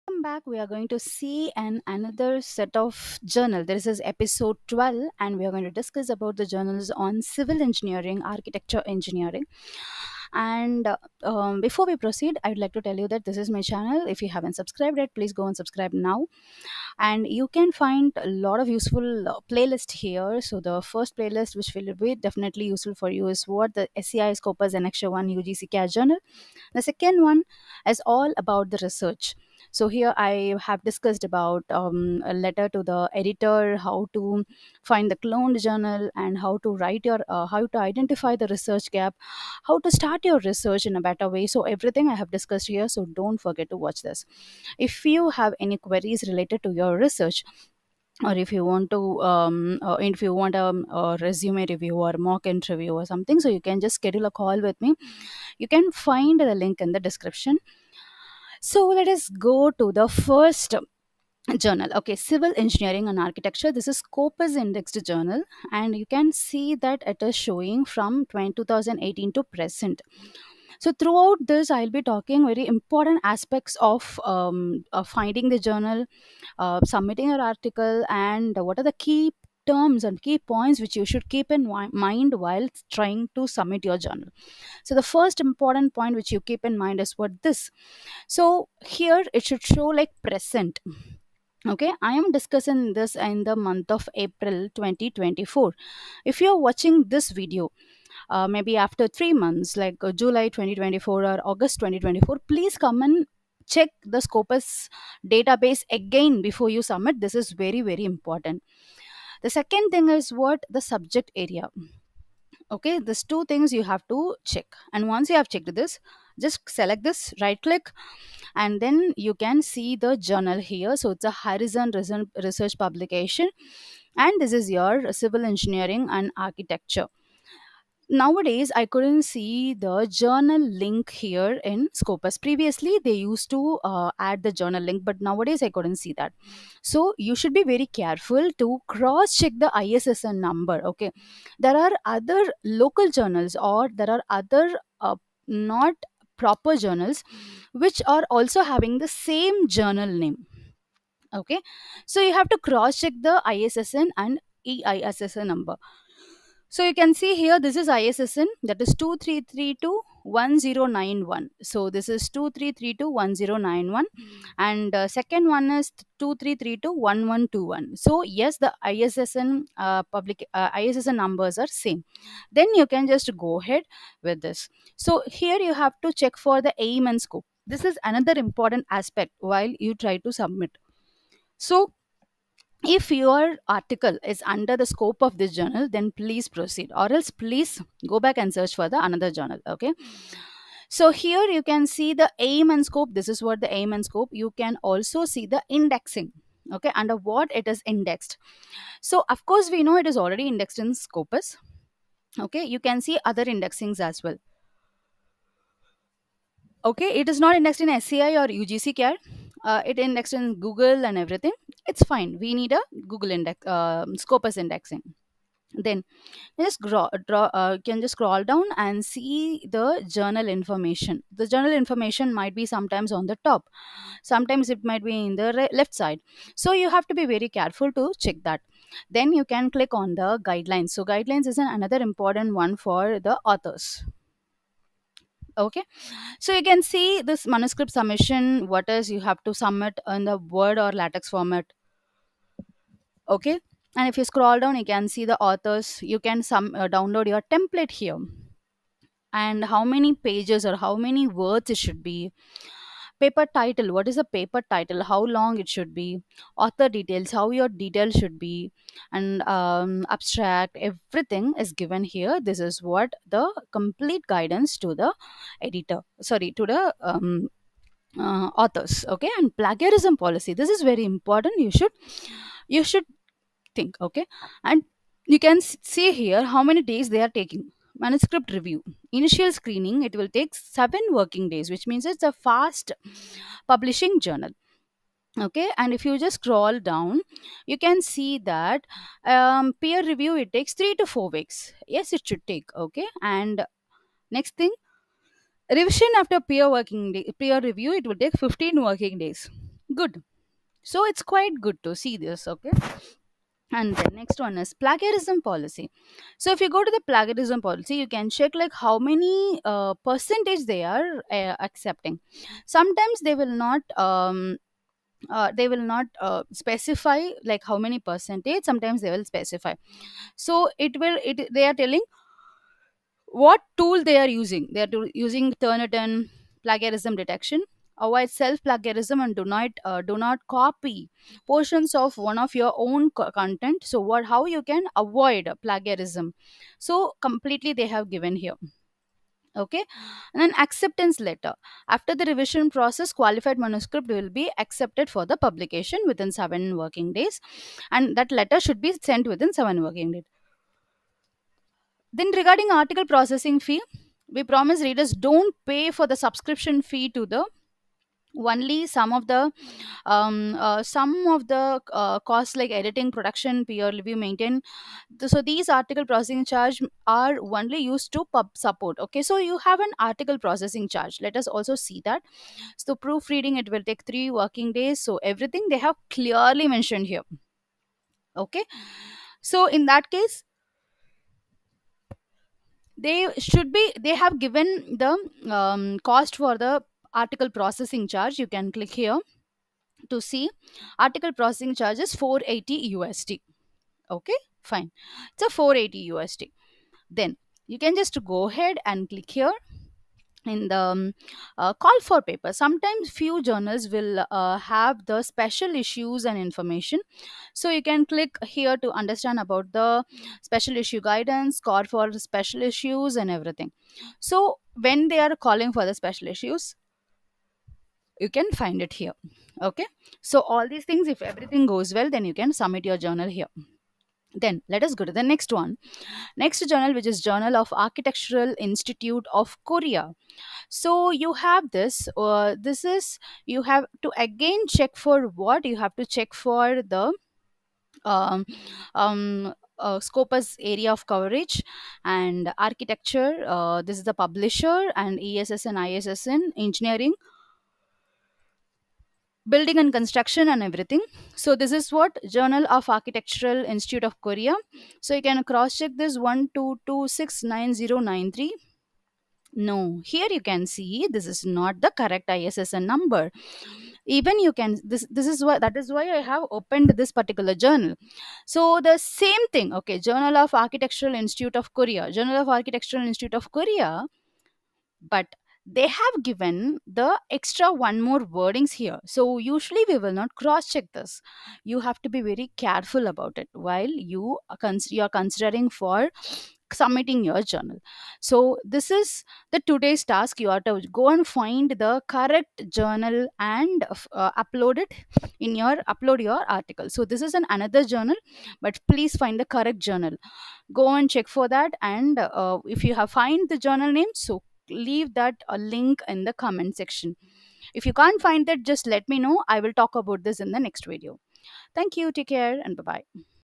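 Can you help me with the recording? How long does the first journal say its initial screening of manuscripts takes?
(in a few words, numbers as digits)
7 working days.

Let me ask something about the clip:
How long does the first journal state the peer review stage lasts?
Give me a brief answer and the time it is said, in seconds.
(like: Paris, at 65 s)
3 to 4 weeks, at 290 s.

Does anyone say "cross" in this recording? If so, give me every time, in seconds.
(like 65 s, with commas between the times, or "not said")
138 s, 152 s, 455 s, 480 s.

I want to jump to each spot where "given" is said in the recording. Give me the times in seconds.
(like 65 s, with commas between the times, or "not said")
261 s, 338 s, 384 s, 476 s.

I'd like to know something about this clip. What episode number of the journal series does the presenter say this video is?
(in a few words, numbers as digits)
12.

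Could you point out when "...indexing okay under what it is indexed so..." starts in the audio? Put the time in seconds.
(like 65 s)
195 s.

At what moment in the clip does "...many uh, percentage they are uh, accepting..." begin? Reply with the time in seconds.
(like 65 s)
308 s.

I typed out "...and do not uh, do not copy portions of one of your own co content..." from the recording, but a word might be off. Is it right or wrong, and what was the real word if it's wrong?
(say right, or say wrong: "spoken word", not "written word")
right.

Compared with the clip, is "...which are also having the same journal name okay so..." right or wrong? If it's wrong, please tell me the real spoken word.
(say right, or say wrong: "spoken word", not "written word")
right.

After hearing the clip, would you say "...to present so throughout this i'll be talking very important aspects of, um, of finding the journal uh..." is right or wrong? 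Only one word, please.
right.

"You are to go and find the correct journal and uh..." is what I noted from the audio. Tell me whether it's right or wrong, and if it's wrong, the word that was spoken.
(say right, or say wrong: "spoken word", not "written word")
right.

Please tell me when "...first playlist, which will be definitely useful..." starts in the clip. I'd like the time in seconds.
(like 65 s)
20 s.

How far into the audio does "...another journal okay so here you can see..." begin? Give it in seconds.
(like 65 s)
189 s.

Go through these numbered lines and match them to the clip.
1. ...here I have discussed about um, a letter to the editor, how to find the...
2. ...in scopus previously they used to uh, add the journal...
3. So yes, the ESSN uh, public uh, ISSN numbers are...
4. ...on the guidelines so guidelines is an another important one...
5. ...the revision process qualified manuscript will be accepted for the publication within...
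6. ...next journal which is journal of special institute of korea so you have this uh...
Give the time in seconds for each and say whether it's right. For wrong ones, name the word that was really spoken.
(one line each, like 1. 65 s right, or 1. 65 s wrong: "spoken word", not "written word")
1. 29 s right
2. 131 s right
3. 167 s wrong: "ISSN", not "ESSN"
4. 229 s right
5. 342 s right
6. 426 s wrong: "architectural", not "special".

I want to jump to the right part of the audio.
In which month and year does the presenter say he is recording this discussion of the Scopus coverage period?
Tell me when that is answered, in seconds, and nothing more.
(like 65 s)
94 s.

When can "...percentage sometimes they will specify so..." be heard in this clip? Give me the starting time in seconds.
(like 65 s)
317 s.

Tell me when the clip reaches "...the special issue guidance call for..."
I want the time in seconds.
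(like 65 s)
409 s.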